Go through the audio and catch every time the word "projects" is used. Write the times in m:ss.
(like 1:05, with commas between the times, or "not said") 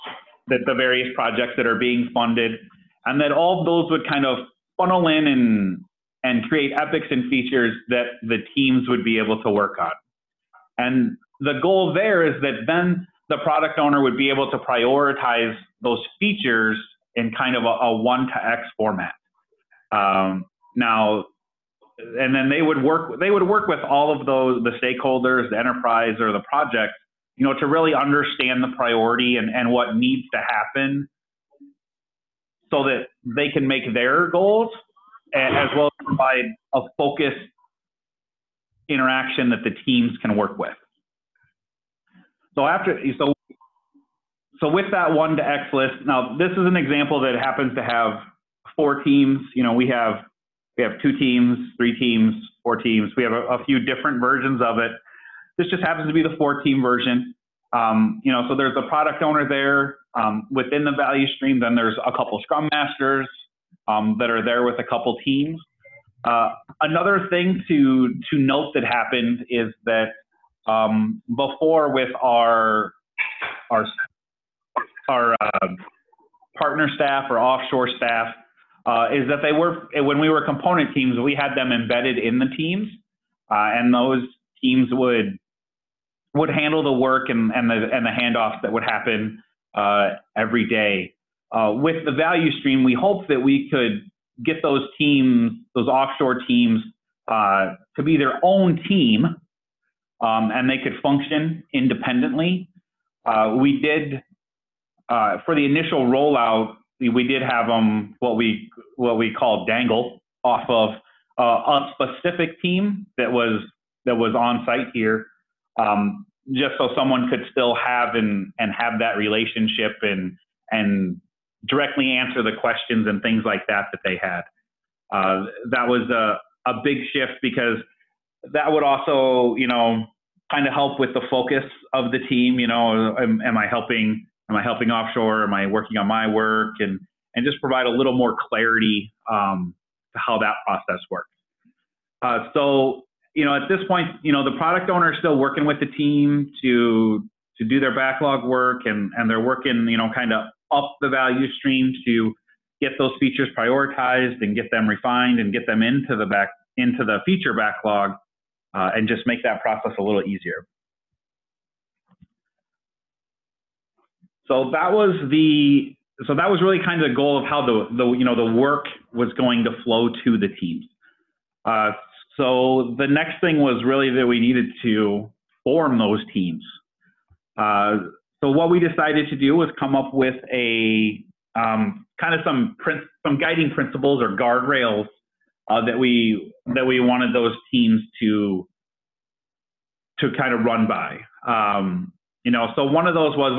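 0:01, 0:26.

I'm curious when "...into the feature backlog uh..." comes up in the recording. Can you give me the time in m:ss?
2:36.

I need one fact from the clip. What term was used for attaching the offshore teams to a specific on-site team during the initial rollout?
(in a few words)
dangle off.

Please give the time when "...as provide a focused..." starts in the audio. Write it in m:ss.
0:35.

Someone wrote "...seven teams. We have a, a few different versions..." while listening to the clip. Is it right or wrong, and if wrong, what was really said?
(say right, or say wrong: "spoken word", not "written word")
wrong: "four", not "seven".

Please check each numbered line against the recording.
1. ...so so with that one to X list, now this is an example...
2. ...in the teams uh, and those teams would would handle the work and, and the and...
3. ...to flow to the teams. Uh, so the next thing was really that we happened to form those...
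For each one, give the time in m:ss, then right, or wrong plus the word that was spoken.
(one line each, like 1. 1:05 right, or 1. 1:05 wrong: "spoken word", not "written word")
1. 0:43 right
2. 1:22 right
3. 2:49 wrong: "needed", not "happened".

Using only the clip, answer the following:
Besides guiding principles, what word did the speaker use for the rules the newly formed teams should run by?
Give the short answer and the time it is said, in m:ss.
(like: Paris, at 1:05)
guardrails, at 3:04.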